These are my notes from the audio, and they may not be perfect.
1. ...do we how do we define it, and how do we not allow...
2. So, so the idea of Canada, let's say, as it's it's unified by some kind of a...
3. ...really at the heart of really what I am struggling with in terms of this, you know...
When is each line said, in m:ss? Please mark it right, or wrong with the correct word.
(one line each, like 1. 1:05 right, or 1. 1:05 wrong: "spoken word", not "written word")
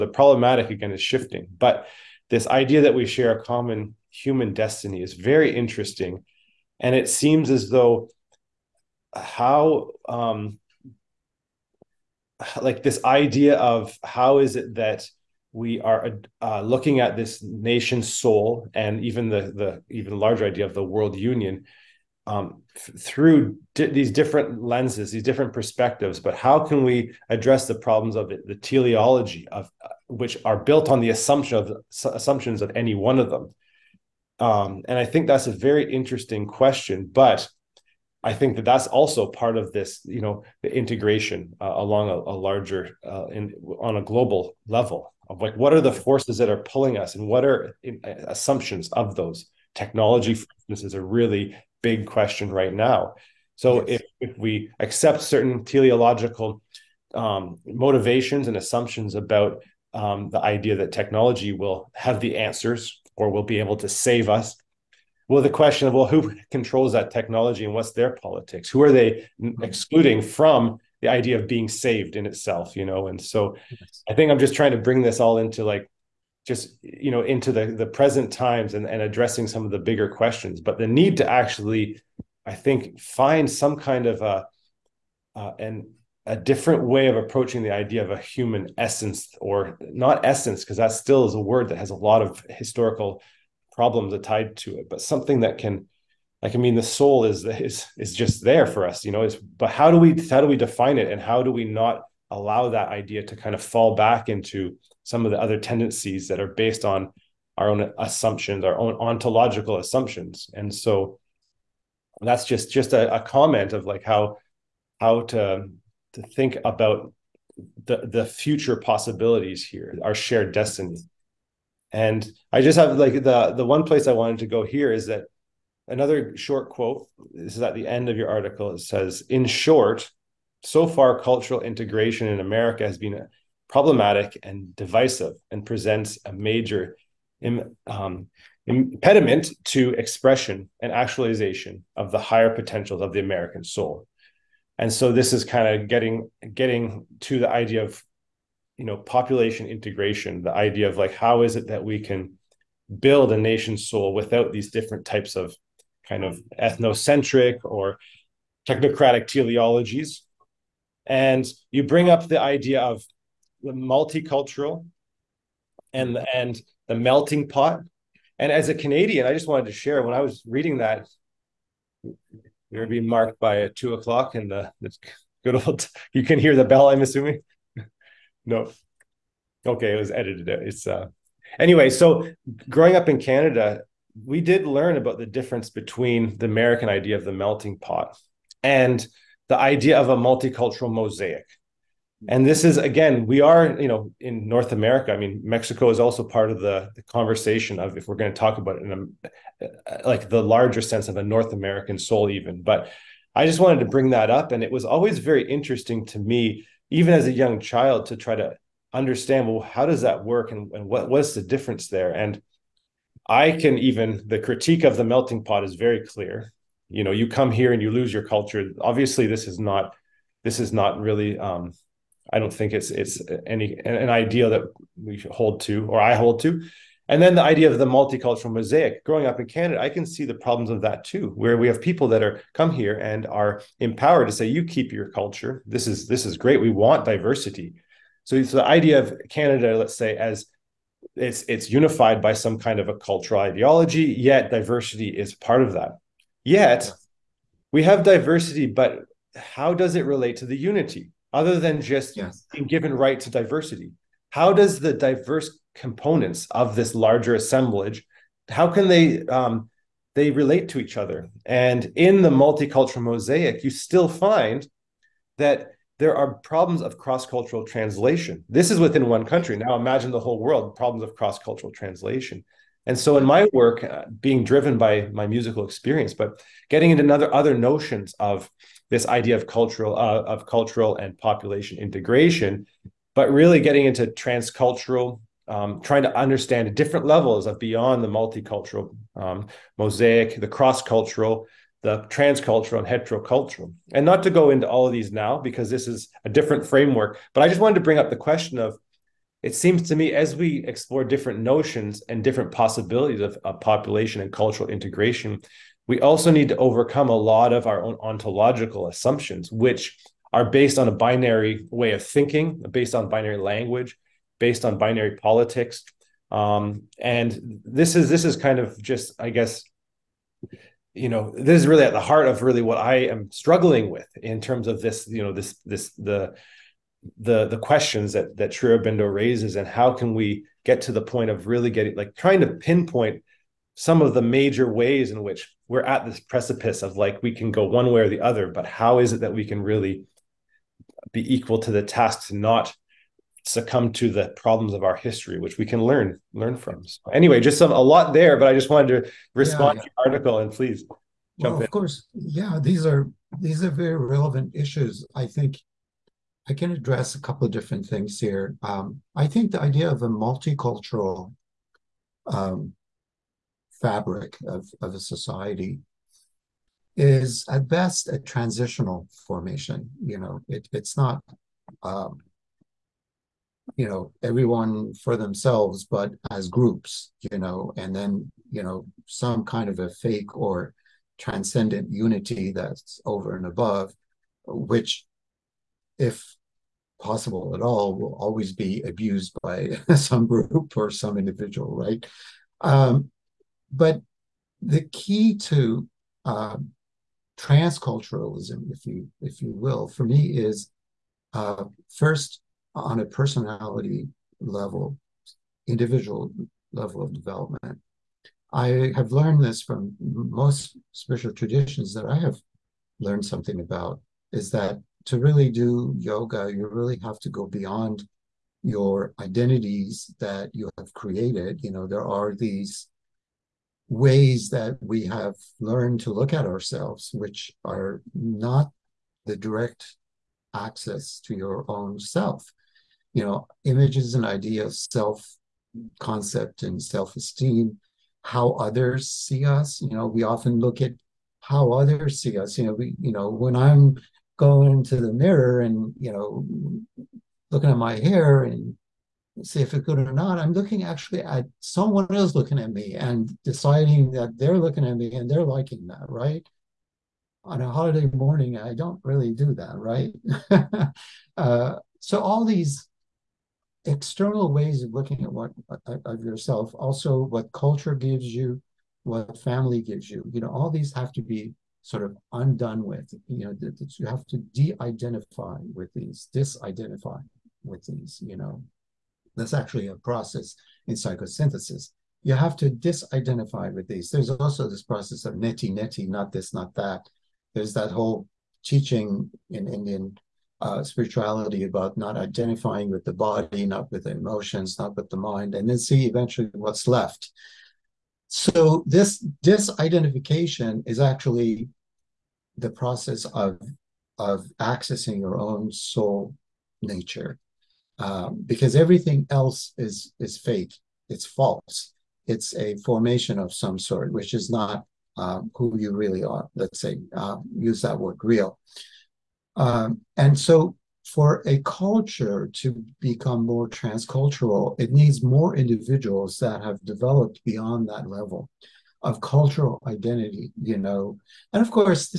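1. 1:39 right
2. 3:58 right
3. 5:21 right.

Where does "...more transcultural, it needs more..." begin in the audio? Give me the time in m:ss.
8:43.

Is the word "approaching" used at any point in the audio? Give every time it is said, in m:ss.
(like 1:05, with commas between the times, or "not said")
1:27.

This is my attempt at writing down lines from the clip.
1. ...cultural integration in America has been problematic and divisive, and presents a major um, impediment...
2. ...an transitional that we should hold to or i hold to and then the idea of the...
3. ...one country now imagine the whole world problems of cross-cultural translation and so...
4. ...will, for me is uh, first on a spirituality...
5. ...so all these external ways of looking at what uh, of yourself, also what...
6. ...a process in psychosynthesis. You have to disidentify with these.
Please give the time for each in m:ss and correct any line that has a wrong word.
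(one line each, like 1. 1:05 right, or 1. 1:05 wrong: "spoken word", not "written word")
1. 2:11 right
2. 3:43 wrong: "ideal", not "transitional"
3. 4:29 right
4. 6:39 wrong: "personality", not "spirituality"
5. 7:41 right
6. 7:59 right.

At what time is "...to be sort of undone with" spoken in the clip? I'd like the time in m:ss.
7:51.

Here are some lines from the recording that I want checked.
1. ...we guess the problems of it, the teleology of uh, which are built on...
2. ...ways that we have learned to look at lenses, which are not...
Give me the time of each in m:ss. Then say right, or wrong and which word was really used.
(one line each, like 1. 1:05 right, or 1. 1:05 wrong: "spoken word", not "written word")
1. 0:26 wrong: "address", not "guess"
2. 7:03 wrong: "ourselves", not "lenses".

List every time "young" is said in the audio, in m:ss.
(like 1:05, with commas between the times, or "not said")
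3:27.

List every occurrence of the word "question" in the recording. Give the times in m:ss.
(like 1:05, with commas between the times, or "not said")
0:36, 0:52, 1:05, 1:20, 4:58, 5:27.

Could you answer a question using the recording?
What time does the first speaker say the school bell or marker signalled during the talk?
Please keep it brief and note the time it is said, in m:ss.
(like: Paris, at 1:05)
Two o'clock, at 2:53.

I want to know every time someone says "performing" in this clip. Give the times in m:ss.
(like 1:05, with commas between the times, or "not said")
not said.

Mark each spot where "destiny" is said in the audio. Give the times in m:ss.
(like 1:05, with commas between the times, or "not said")
0:04, 2:00.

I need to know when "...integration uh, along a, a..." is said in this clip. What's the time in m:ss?
0:40.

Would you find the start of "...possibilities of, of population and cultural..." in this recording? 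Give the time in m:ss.
5:02.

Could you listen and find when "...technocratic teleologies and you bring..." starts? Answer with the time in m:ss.
2:38.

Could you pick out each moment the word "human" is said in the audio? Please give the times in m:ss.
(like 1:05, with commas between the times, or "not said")
0:04, 1:28.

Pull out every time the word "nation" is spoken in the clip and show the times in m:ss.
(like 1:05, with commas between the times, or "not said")
0:17, 2:33.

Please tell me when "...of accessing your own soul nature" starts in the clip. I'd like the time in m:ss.
8:24.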